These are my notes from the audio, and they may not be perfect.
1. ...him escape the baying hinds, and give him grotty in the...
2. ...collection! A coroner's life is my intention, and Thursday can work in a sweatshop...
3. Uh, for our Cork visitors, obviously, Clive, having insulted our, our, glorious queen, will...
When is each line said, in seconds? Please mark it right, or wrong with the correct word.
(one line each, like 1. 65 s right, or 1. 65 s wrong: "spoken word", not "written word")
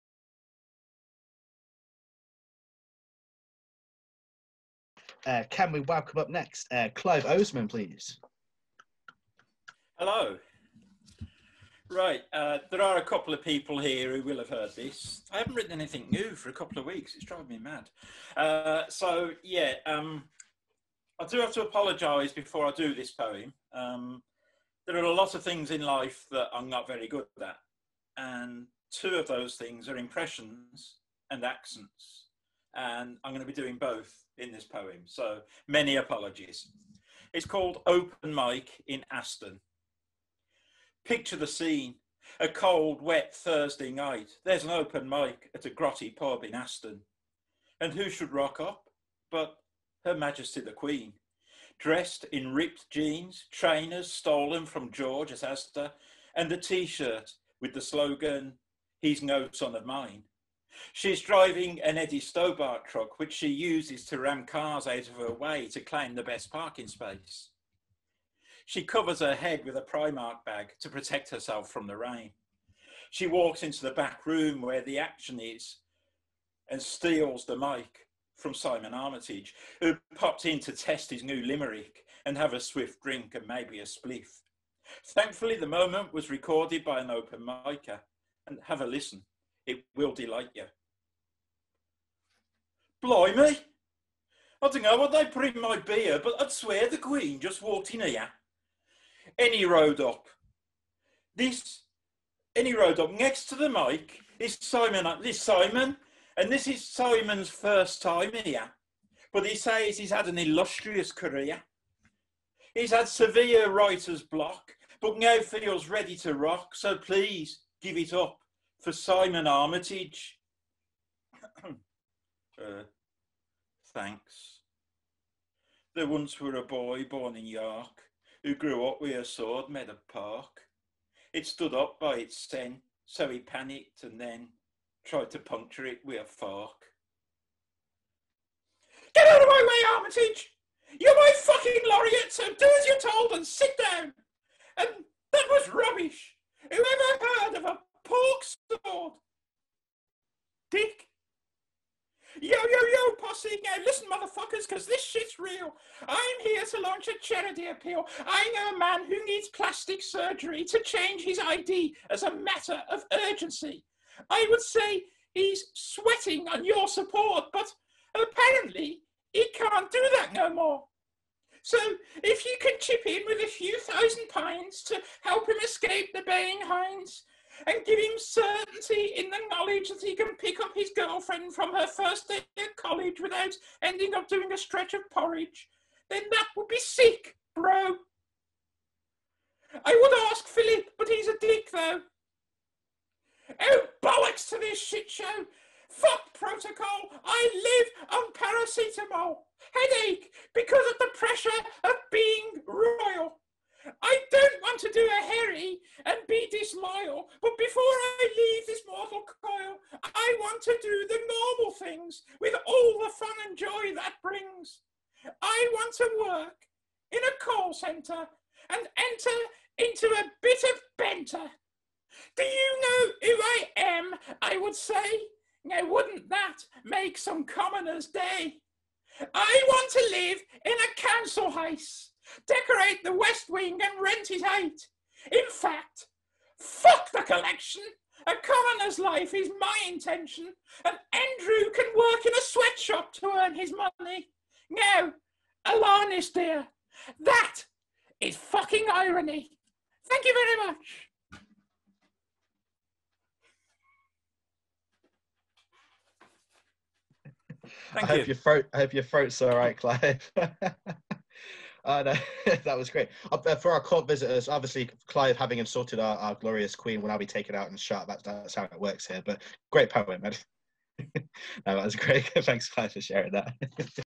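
1. 175 s wrong: "certainty", not "grotty"
2. 237 s wrong: "Andrew", not "Thursday"
3. 263 s right.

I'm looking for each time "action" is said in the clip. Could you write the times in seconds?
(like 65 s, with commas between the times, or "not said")
74 s.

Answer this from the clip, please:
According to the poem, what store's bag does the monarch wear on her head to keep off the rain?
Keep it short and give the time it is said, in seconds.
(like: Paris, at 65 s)
Primark, at 69 s.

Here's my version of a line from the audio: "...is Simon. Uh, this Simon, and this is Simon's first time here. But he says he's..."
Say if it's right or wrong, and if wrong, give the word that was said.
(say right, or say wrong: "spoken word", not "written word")
right.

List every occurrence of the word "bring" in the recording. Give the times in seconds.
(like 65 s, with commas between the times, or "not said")
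95 s, 214 s.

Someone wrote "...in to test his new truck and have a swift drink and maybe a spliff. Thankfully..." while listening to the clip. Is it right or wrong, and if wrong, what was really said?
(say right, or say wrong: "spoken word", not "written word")
wrong: "limerick", not "truck".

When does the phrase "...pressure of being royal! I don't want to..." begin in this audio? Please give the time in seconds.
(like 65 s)
201 s.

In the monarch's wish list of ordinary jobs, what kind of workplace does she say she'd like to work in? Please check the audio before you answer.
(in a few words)
a call centre.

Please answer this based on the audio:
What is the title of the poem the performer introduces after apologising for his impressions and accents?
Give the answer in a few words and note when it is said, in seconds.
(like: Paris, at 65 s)
Open Mic in Aston, at 37 s.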